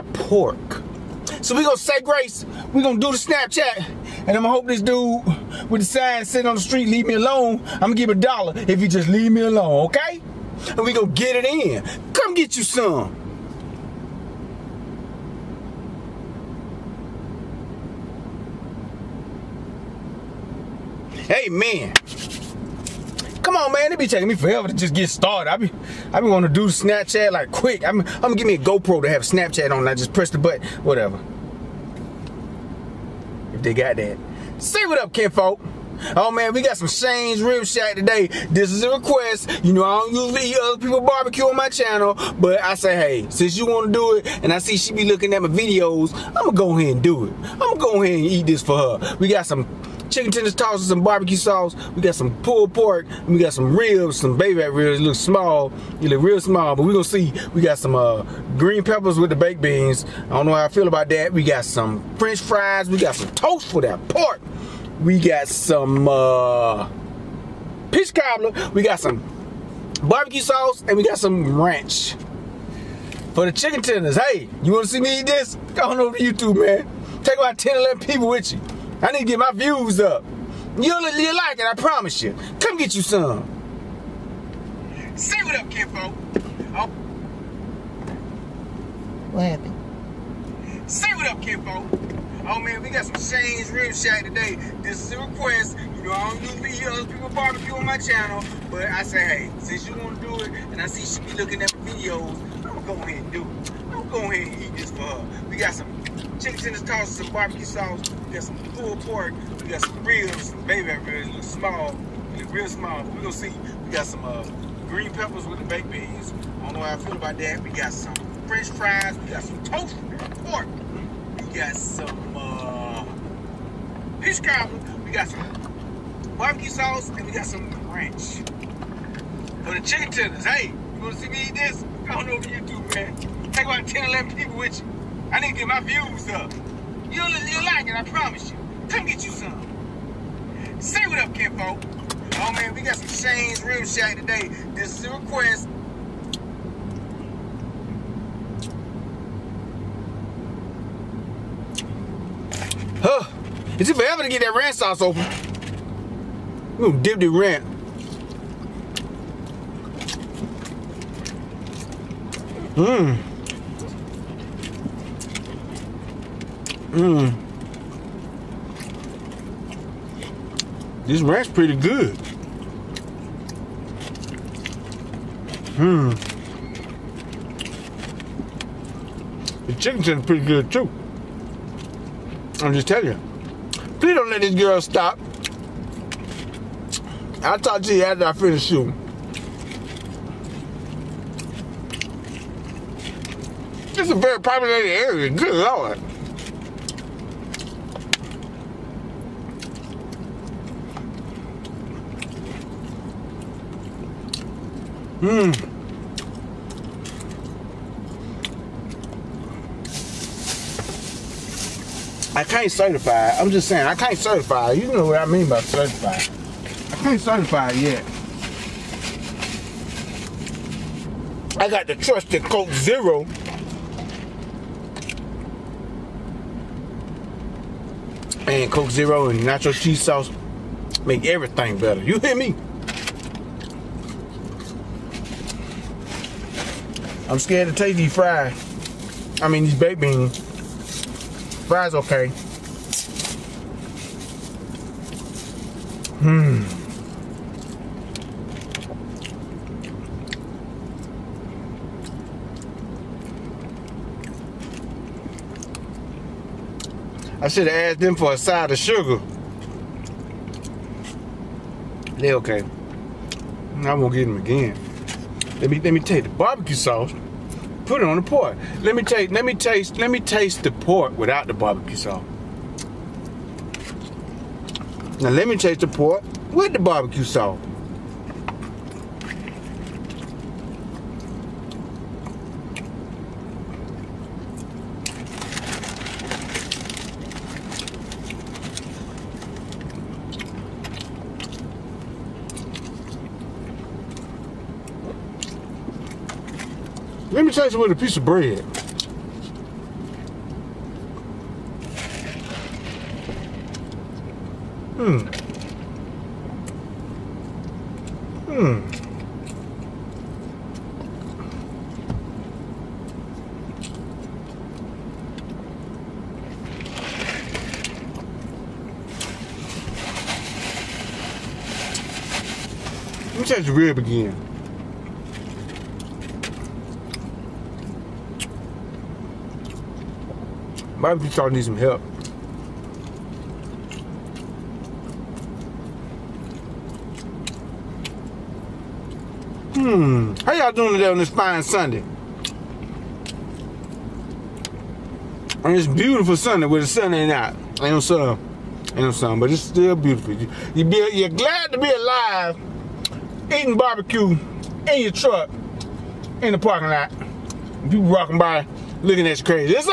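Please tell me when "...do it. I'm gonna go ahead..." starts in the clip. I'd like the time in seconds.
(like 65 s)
47 s.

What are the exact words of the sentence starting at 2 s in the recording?
We gonna do the Snapchat, and I'ma hope this dude with the sign sitting on the street leave me alone.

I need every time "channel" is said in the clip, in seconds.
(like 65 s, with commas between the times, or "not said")
41 s, 97 s.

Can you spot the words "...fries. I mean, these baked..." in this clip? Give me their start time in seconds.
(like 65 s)
238 s.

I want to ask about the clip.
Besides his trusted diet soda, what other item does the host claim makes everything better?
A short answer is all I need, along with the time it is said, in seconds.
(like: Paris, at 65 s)
nacho cheese sauce, at 229 s.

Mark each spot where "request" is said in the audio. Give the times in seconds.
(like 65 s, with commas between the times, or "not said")
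38 s, 95 s, 145 s.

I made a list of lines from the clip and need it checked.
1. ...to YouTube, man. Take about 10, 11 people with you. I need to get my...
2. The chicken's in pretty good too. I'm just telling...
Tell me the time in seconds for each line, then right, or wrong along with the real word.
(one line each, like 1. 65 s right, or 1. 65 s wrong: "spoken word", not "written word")
1. 76 s right
2. 179 s right.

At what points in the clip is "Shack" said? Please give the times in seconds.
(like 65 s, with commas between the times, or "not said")
37 s, 93 s, 143 s.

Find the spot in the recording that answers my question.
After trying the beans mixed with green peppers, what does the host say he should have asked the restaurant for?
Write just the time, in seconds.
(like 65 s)
258 s.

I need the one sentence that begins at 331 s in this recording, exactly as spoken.
Barbecue, you starting to need some help.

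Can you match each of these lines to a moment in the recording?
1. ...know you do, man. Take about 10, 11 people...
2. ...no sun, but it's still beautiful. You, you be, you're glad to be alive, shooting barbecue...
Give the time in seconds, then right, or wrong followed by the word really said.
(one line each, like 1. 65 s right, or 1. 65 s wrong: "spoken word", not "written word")
1. 132 s right
2. 348 s wrong: "eating", not "shooting".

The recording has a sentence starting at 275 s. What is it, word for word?
Now let me taste the pork with the barbecue sauce.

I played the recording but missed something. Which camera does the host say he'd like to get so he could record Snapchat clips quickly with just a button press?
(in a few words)
GoPro.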